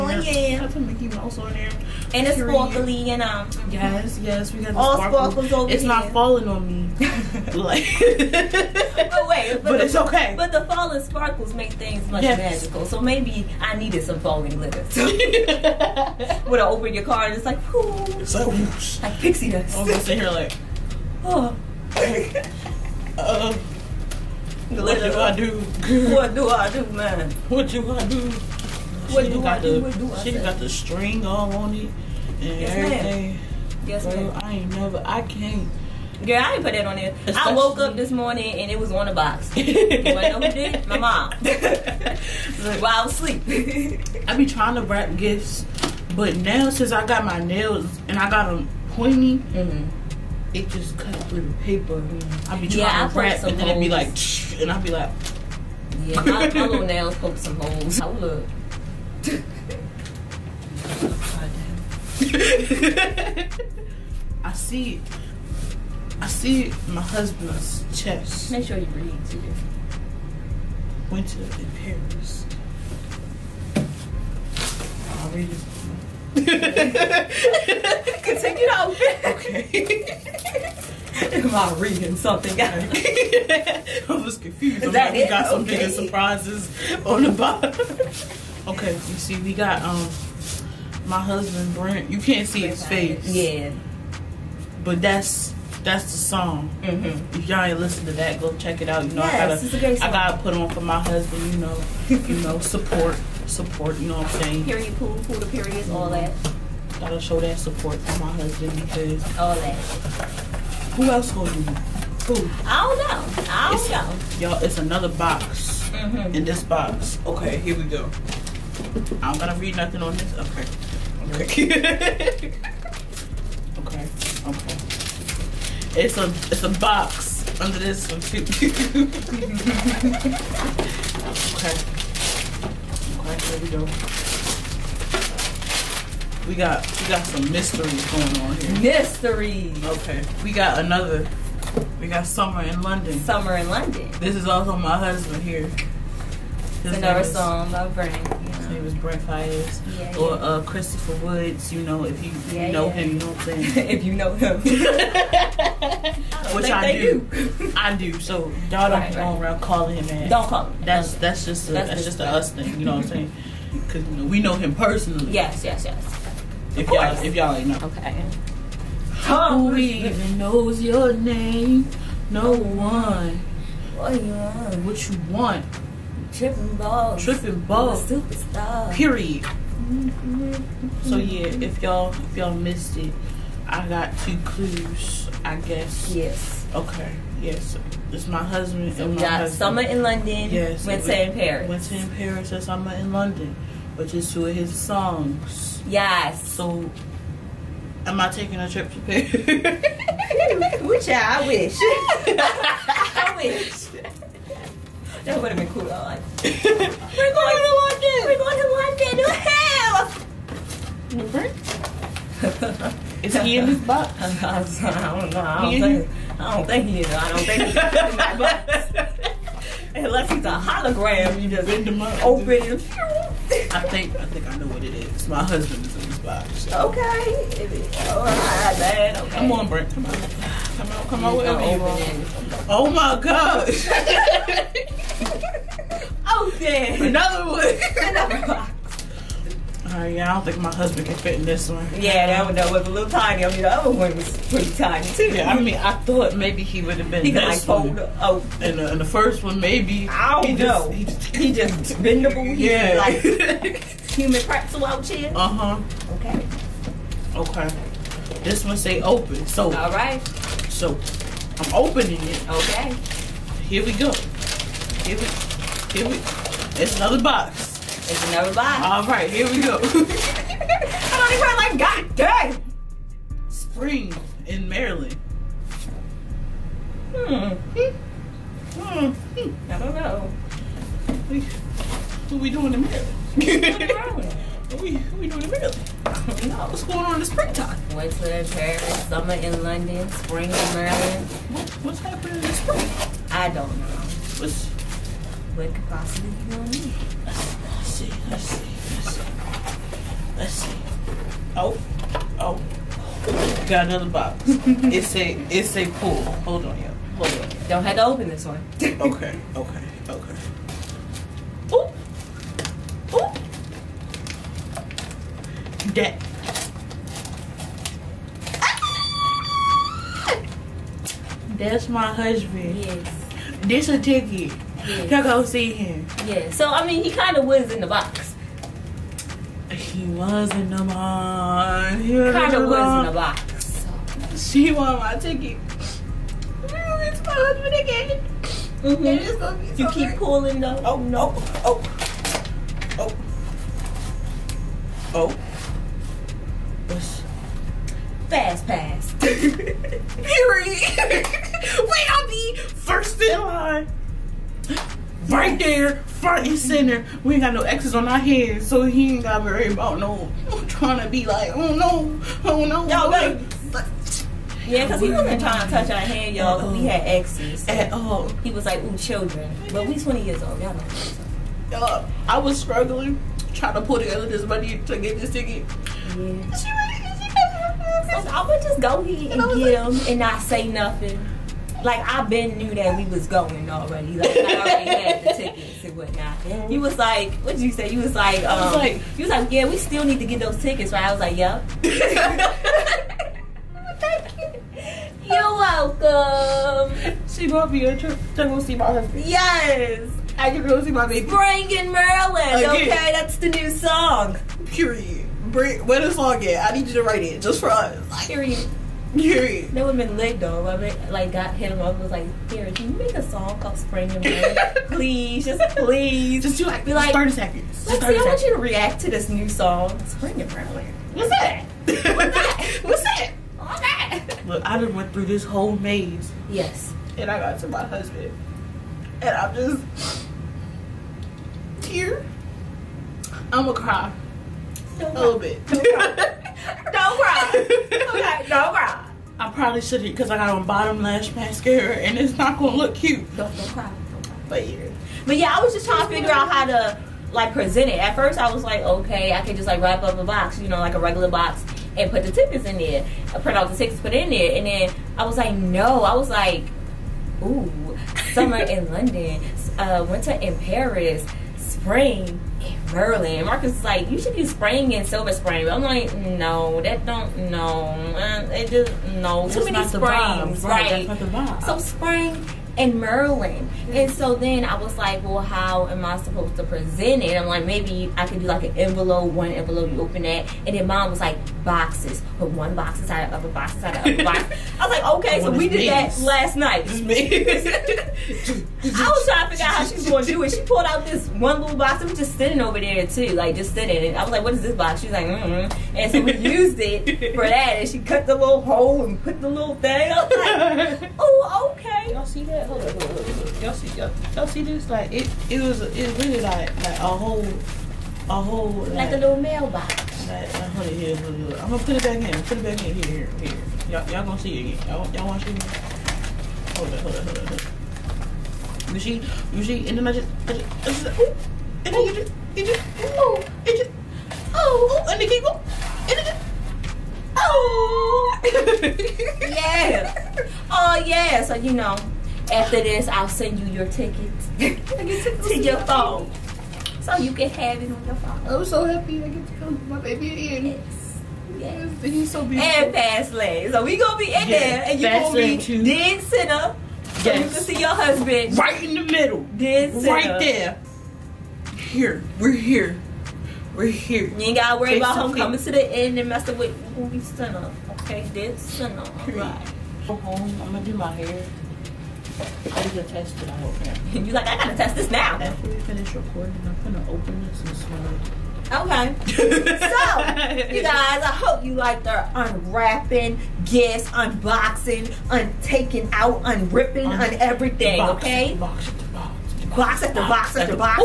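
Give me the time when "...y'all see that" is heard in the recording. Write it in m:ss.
8:22.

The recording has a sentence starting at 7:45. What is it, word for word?
But I'm like, no, that don't no.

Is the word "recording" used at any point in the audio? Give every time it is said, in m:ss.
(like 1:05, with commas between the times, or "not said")
9:26.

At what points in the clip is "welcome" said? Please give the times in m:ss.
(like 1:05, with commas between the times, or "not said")
6:35.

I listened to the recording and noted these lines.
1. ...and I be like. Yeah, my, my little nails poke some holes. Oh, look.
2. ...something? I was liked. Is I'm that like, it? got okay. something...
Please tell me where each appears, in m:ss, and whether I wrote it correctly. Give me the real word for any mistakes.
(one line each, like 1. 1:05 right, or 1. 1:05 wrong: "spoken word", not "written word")
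1. 0:54 right
2. 1:22 wrong: "confused", not "liked".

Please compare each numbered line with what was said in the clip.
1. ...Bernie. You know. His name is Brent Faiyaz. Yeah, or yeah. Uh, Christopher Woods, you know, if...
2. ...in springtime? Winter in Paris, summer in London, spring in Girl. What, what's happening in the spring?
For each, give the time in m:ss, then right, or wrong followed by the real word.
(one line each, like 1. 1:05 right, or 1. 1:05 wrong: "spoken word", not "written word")
1. 2:27 right
2. 4:47 wrong: "Maryland", not "Girl".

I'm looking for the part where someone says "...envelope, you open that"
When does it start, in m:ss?
7:59.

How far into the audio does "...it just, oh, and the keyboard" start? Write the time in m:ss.
8:43.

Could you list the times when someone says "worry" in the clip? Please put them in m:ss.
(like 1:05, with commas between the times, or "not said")
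5:59, 9:14.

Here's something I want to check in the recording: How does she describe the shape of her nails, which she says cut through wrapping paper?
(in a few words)
Pointy.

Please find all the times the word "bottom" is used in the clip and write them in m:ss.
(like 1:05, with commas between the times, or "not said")
1:27, 7:20.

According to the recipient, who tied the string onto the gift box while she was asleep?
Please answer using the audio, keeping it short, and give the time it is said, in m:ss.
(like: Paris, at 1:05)
My mom, at 0:40.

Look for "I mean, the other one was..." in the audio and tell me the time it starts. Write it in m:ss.
4:03.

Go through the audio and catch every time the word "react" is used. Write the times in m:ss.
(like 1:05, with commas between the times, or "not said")
6:58.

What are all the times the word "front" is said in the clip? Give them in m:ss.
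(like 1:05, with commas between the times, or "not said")
5:56.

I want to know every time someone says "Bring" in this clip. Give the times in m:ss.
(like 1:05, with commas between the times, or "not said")
6:41, 6:45.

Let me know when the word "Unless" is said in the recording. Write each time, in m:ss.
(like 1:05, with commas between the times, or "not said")
3:39.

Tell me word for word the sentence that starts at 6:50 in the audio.
I mean, like got hit him up was like, here, can you make a song called Spring and Rain?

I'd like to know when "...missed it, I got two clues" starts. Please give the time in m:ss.
3:02.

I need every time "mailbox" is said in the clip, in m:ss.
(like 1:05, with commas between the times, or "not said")
8:29.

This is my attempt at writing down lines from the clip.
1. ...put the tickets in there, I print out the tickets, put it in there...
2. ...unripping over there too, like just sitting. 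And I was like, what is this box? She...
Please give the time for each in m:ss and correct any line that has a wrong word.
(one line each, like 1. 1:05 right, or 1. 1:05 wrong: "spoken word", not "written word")
1. 7:32 right
2. 8:12 wrong: "sitting", not "unripping".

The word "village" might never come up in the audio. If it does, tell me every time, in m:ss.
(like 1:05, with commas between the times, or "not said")
not said.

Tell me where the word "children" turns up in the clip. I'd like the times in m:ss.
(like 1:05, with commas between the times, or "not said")
6:08.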